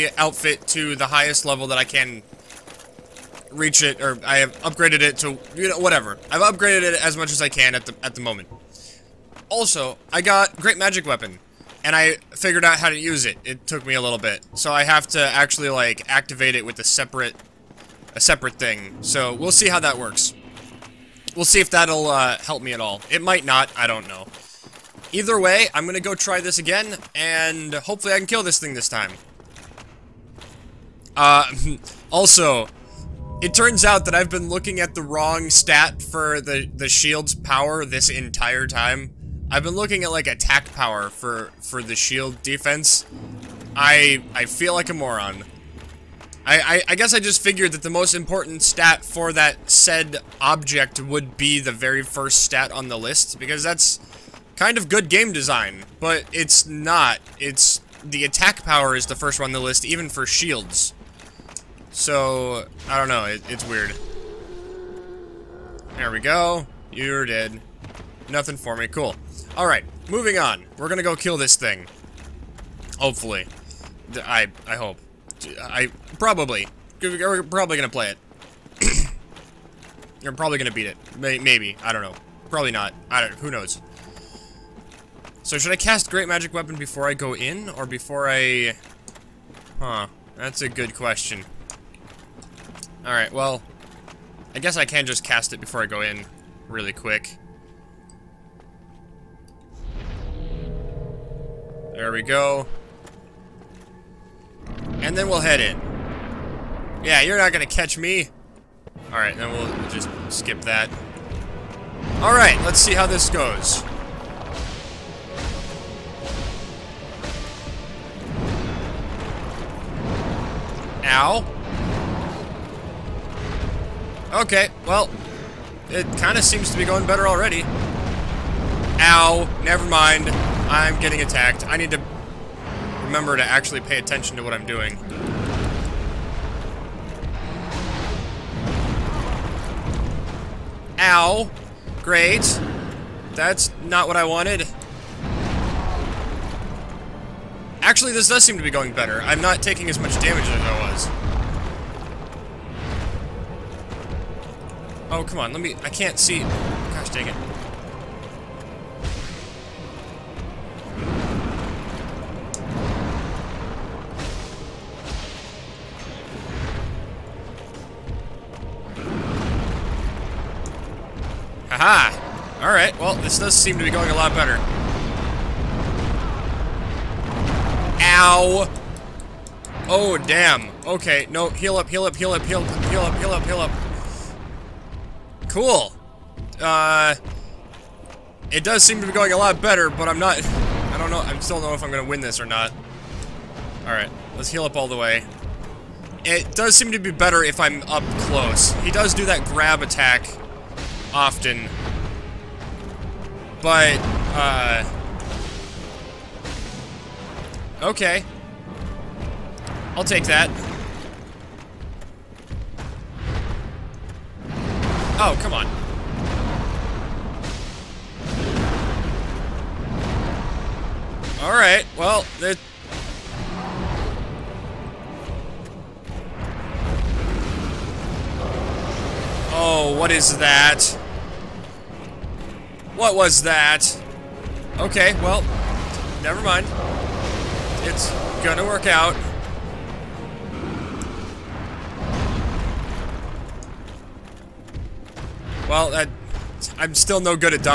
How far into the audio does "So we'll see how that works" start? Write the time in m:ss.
0:19.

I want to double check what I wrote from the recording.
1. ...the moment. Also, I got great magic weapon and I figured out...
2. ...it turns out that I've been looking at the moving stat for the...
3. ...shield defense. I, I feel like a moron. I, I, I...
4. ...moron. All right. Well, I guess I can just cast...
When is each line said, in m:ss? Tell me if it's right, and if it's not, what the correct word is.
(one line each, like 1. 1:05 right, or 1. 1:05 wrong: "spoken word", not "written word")
1. 0:08 right
2. 0:33 wrong: "wrong", not "moving"
3. 0:41 right
4. 1:30 wrong: "question", not "moron".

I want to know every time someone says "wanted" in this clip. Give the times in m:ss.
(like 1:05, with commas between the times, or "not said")
2:24.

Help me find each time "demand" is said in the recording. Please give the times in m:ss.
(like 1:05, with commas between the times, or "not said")
not said.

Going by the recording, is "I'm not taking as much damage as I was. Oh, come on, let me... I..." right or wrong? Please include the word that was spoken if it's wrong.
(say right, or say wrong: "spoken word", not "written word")
right.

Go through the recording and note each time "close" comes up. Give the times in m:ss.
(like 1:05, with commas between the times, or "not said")
3:18.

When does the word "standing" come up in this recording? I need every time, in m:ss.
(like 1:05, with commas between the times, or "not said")
not said.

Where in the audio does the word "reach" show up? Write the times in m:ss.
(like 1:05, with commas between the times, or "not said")
0:03.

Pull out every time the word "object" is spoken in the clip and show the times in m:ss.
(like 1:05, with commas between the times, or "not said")
0:50.